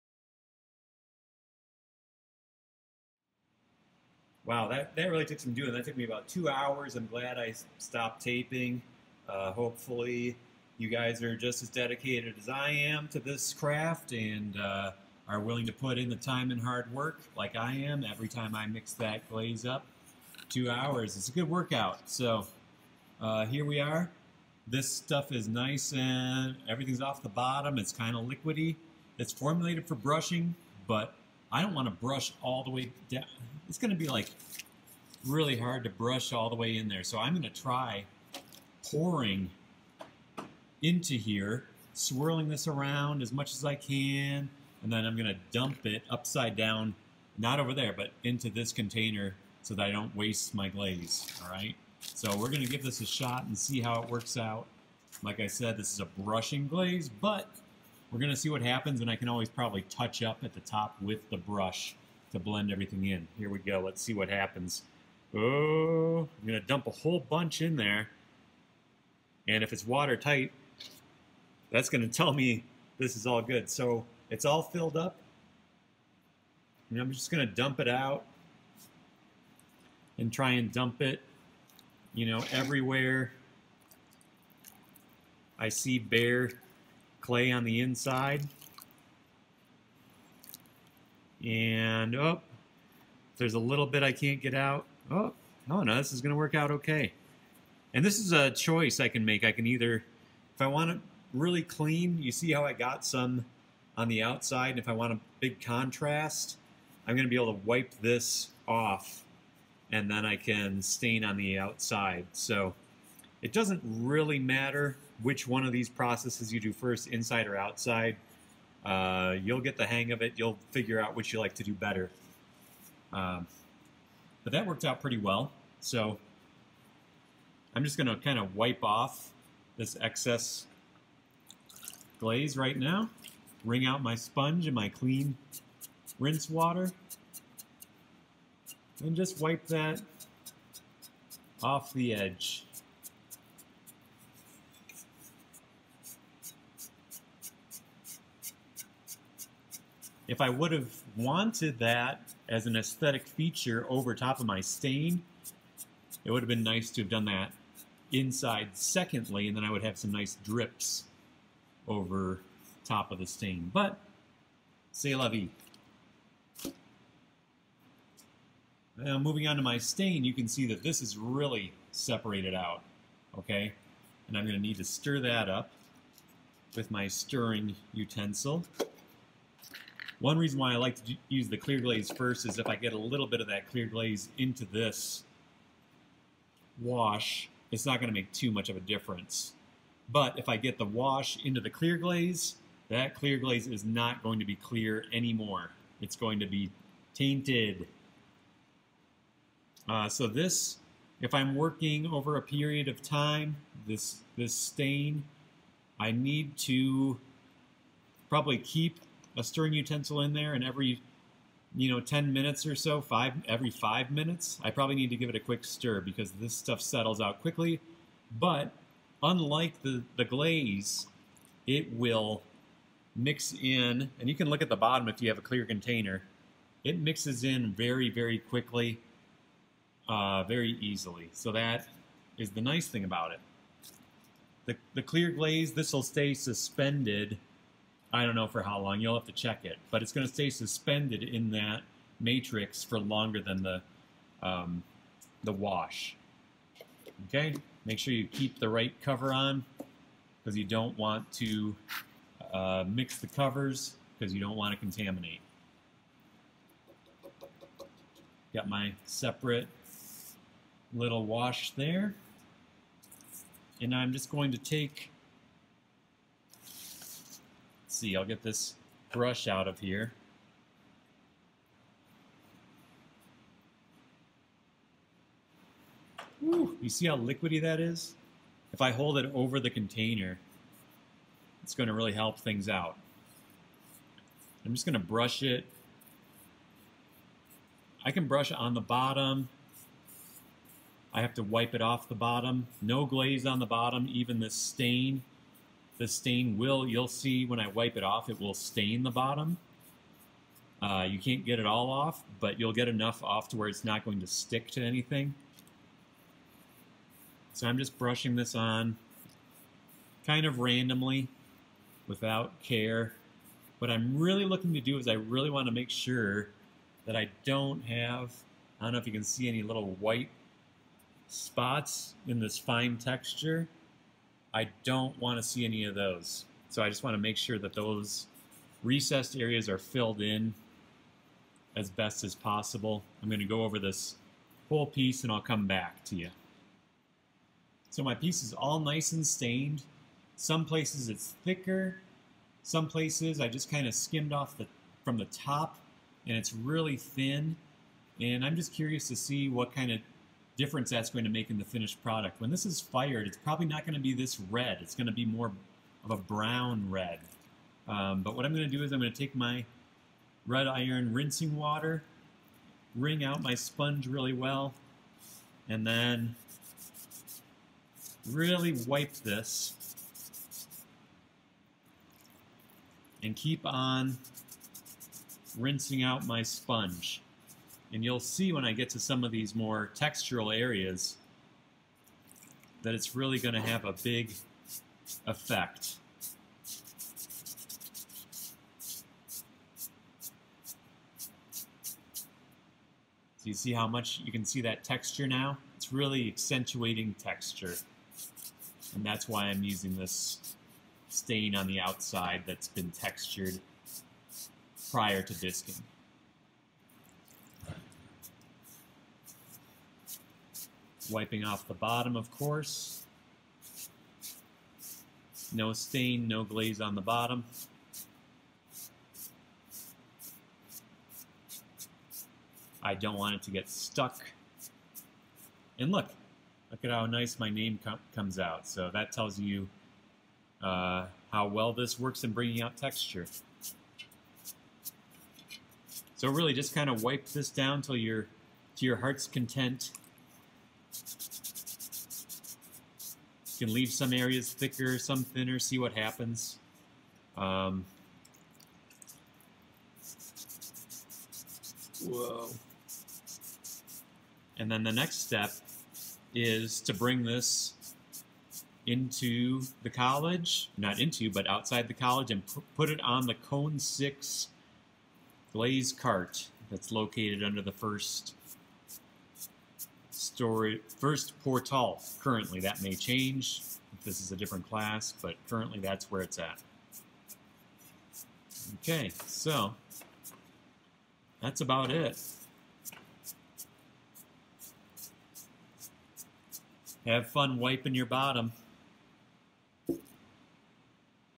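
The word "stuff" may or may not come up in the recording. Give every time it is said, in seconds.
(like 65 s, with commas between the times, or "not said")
24 s, 216 s.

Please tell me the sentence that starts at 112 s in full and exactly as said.
So it doesn't really matter which one of these processes you do first, inside or outside.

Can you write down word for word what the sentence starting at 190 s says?
But if I get the wash into the clear glaze, that clear glaze is not going to be clear anymore.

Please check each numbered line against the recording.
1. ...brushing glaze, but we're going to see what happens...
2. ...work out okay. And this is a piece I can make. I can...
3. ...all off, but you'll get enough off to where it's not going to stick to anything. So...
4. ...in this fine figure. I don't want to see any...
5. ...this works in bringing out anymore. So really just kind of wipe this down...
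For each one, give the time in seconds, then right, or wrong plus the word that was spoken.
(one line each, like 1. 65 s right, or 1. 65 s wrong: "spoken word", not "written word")
1. 56 s right
2. 96 s wrong: "choice", not "piece"
3. 301 s right
4. 322 s wrong: "texture", not "figure"
5. 431 s wrong: "texture", not "anymore".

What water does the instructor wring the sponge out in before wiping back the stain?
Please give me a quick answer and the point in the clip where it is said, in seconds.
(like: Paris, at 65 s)
Red iron, at 360 s.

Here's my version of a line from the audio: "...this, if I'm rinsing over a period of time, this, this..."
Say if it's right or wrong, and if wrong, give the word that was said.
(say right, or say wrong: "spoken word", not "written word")
wrong: "working", not "rinsing".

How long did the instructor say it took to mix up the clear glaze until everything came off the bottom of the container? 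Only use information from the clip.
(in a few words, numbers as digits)
2 hours.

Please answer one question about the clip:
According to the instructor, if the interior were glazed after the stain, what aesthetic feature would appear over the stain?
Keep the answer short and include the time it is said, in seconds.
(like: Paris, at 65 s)
Drips, at 160 s.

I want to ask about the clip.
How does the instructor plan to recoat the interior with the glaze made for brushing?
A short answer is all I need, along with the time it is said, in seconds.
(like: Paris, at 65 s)
Pouring, at 38 s.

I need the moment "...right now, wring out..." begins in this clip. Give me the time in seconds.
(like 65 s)
132 s.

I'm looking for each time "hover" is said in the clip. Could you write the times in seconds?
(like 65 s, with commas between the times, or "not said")
not said.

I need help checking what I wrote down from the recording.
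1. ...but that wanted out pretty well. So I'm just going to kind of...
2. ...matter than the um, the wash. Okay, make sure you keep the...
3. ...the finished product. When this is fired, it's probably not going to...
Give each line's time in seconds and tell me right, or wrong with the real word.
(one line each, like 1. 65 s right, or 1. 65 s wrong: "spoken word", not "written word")
1. 124 s wrong: "worked", not "wanted"
2. 242 s wrong: "longer", not "matter"
3. 351 s right.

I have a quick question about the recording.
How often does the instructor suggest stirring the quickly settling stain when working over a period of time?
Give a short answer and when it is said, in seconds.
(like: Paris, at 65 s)
Every 5 minutes, at 213 s.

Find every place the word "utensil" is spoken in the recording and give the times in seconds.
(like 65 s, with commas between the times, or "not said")
177 s, 209 s.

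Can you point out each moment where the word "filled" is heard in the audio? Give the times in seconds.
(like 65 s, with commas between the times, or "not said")
74 s, 329 s.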